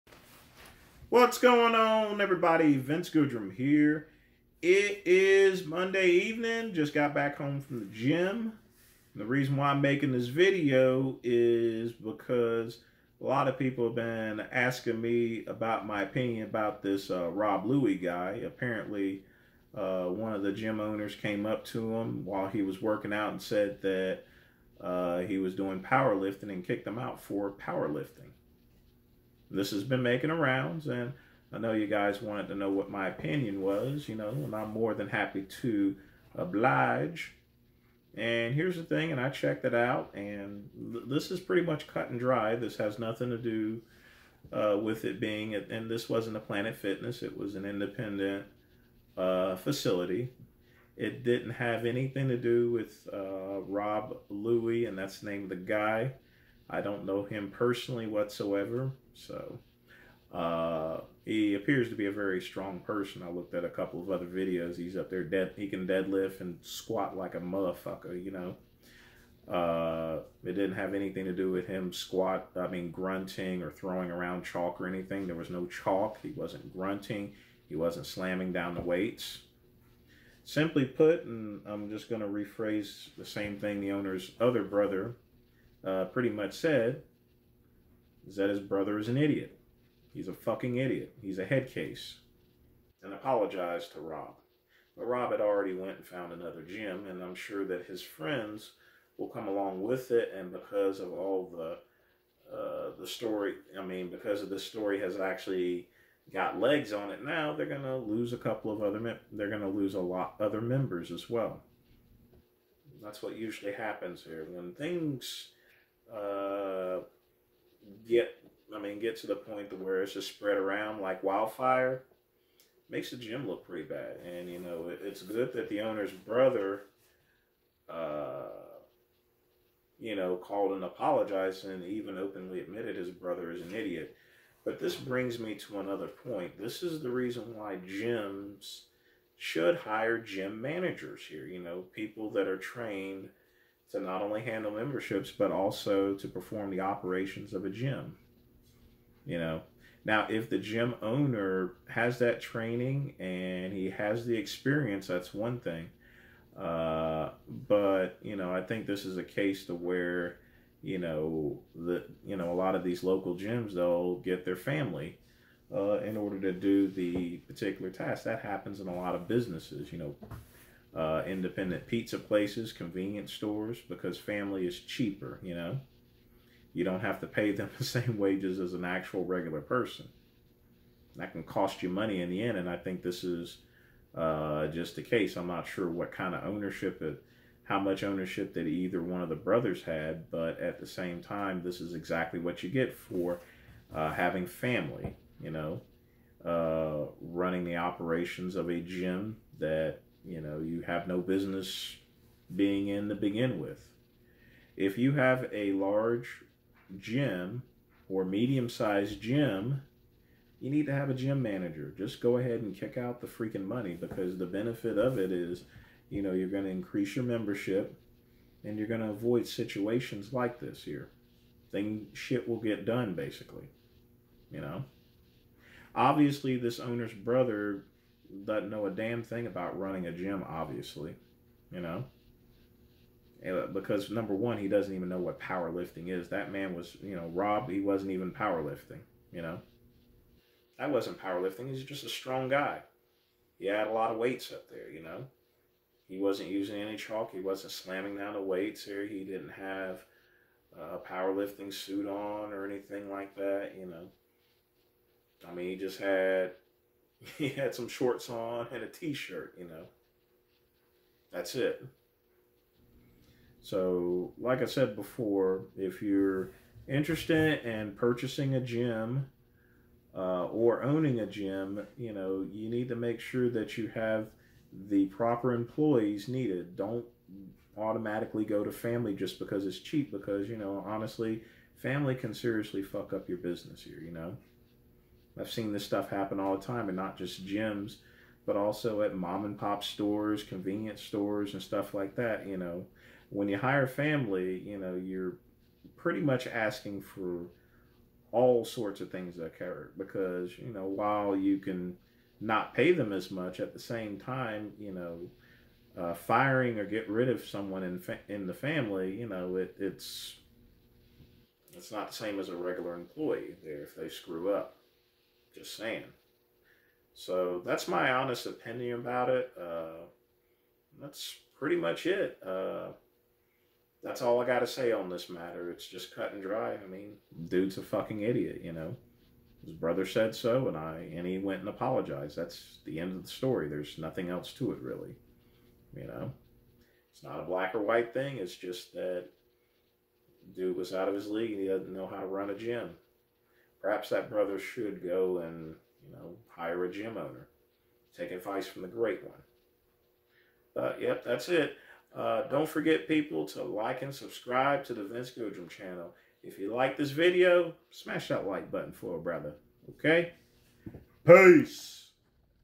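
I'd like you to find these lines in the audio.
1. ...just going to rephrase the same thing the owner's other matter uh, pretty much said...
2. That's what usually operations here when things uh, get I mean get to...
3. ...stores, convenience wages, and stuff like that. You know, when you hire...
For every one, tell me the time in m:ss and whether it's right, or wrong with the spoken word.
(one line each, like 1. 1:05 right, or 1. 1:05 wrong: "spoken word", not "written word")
1. 1:21 wrong: "brother", not "matter"
2. 1:53 wrong: "happens", not "operations"
3. 4:49 wrong: "stores", not "wages".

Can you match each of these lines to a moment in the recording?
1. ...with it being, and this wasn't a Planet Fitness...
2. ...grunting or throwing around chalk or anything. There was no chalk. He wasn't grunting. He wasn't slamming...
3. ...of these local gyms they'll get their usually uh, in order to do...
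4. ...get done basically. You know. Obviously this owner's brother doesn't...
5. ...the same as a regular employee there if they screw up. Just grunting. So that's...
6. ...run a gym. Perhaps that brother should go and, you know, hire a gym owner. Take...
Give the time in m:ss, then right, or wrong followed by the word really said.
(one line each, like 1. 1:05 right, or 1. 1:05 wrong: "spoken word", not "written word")
1. 0:44 right
2. 1:12 right
3. 2:42 wrong: "family", not "usually"
4. 3:42 right
5. 5:12 wrong: "saying", not "grunting"
6. 5:42 right.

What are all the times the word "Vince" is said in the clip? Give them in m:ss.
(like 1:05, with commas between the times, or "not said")
0:02, 5:55.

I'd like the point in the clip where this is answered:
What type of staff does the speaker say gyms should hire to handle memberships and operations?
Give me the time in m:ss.
2:20.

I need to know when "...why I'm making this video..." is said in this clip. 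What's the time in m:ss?
0:09.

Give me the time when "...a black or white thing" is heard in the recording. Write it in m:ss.
5:37.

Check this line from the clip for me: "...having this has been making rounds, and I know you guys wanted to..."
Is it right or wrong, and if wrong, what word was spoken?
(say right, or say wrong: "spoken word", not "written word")
wrong: "powerlifting", not "having".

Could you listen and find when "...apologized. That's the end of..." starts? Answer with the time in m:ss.
5:31.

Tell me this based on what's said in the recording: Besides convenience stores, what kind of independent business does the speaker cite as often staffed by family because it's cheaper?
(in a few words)
Pizza places.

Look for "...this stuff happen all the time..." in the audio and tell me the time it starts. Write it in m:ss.
4:45.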